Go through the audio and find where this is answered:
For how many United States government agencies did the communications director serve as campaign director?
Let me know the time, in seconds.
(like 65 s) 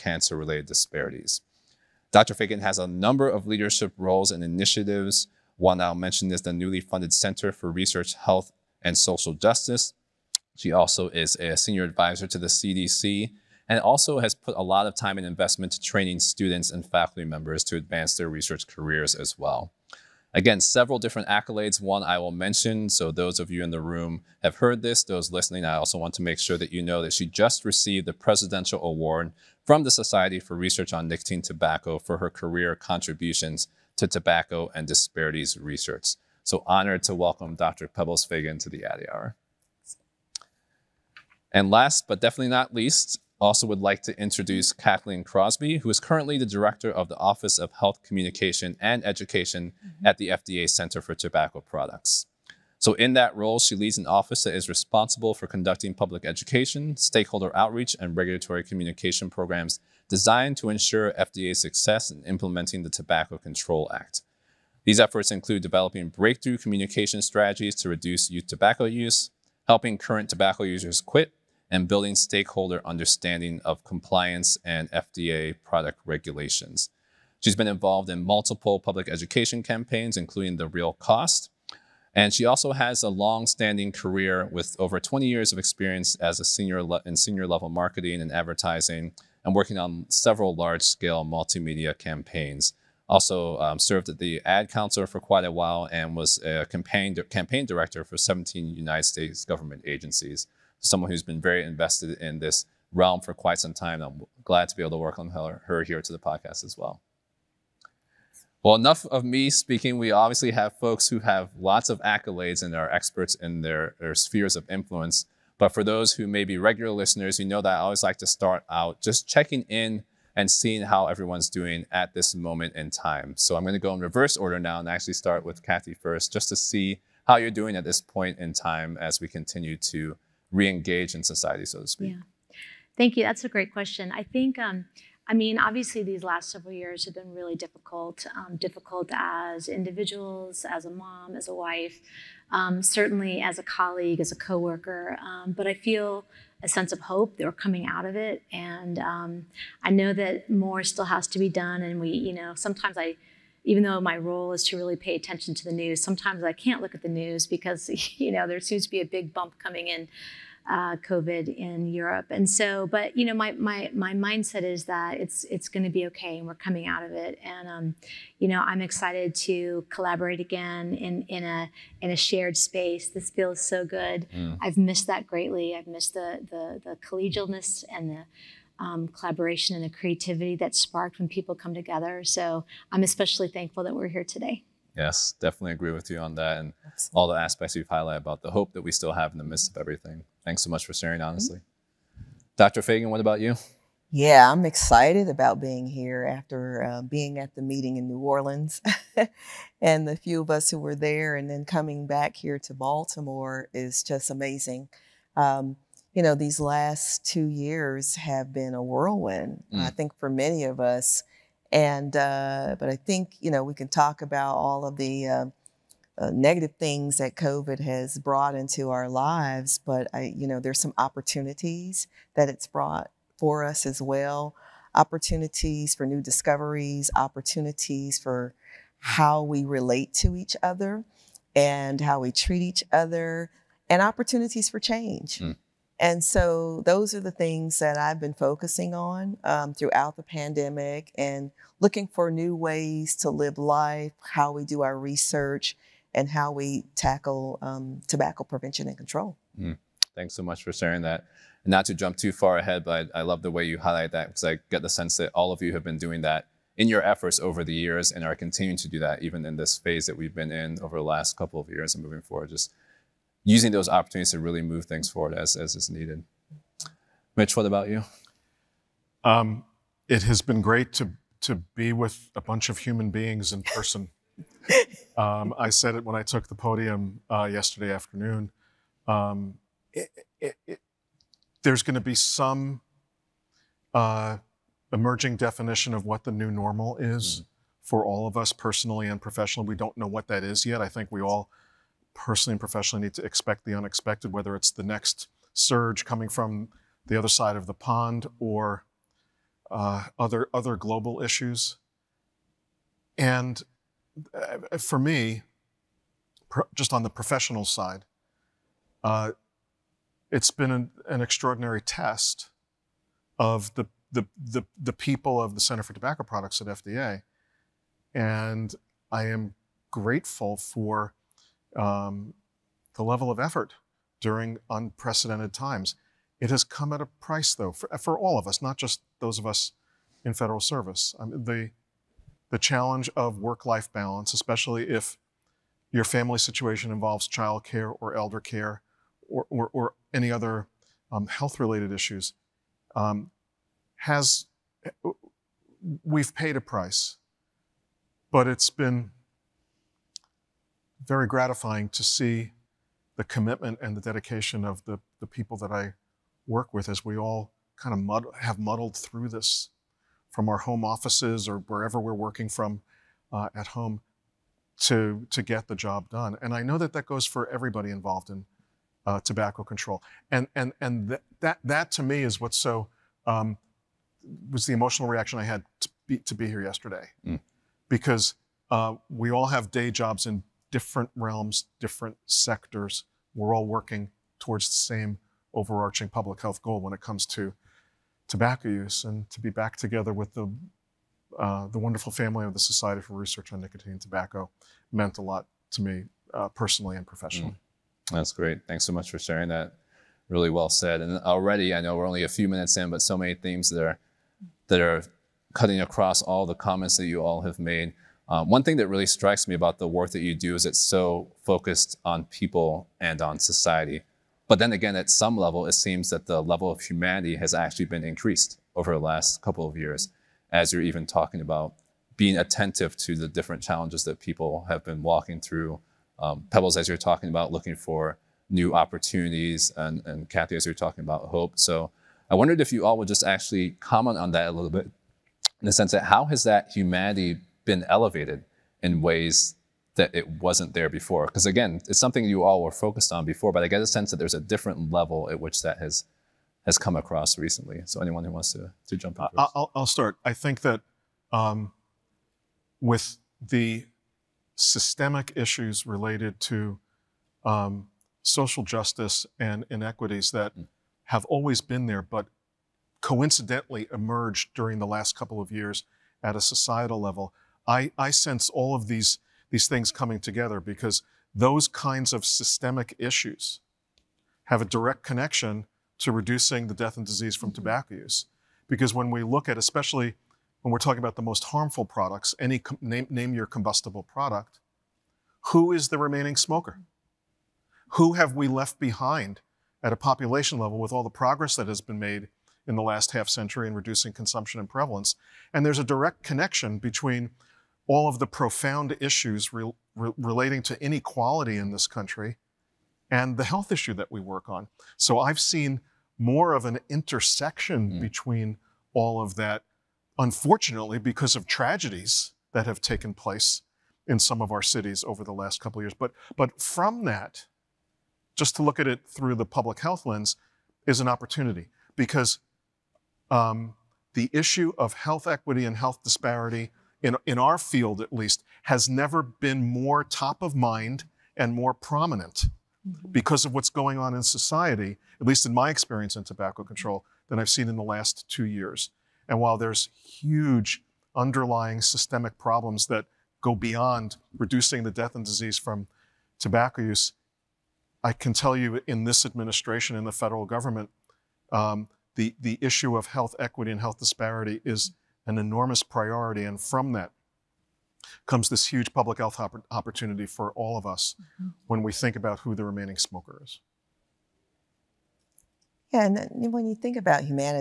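98 s.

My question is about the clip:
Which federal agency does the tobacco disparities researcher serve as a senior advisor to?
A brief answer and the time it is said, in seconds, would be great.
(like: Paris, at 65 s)
CDC, at 12 s.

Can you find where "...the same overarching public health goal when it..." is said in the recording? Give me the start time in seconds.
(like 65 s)
384 s.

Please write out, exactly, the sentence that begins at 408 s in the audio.
Uh, one thing that really strikes me about the work that you do is it's so focused on people and on society.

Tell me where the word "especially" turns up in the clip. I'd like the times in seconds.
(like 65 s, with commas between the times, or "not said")
183 s, 334 s, 479 s.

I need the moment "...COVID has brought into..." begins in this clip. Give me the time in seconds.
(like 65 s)
217 s.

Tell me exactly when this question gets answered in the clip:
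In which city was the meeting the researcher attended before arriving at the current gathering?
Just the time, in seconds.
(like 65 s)
198 s.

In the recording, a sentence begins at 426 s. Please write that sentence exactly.
Um, Pebbles, as you're talking about, looking for new opportunities, and, and Kathy, as you're talking about hope.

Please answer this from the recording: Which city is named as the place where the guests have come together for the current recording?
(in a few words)
Baltimore.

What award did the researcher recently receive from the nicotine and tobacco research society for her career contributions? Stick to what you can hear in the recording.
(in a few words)
Presidential Award.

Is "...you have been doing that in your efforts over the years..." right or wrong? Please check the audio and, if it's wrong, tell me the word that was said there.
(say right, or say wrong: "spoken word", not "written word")
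right.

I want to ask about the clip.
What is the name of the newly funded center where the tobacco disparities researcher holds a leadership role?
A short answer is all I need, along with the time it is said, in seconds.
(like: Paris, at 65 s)
Center for Research, Health, and Social Justice, at 7 s.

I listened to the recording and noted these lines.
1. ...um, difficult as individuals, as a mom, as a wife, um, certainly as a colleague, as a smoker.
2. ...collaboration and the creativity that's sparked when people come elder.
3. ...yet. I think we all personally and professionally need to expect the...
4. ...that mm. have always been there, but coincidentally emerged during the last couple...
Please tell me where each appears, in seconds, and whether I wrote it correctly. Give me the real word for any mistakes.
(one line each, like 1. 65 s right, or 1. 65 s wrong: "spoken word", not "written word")
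1. 138 s wrong: "coworker", not "smoker"
2. 179 s wrong: "together", not "elder"
3. 290 s right
4. 460 s right.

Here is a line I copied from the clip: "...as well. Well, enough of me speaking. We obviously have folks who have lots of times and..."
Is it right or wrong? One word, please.
wrong.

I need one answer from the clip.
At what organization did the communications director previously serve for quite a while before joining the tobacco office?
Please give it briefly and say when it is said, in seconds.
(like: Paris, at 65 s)
Ad Council, at 94 s.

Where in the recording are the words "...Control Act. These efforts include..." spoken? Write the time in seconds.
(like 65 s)
63 s.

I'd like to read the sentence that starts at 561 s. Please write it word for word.
when we think about who the remaining smoker is.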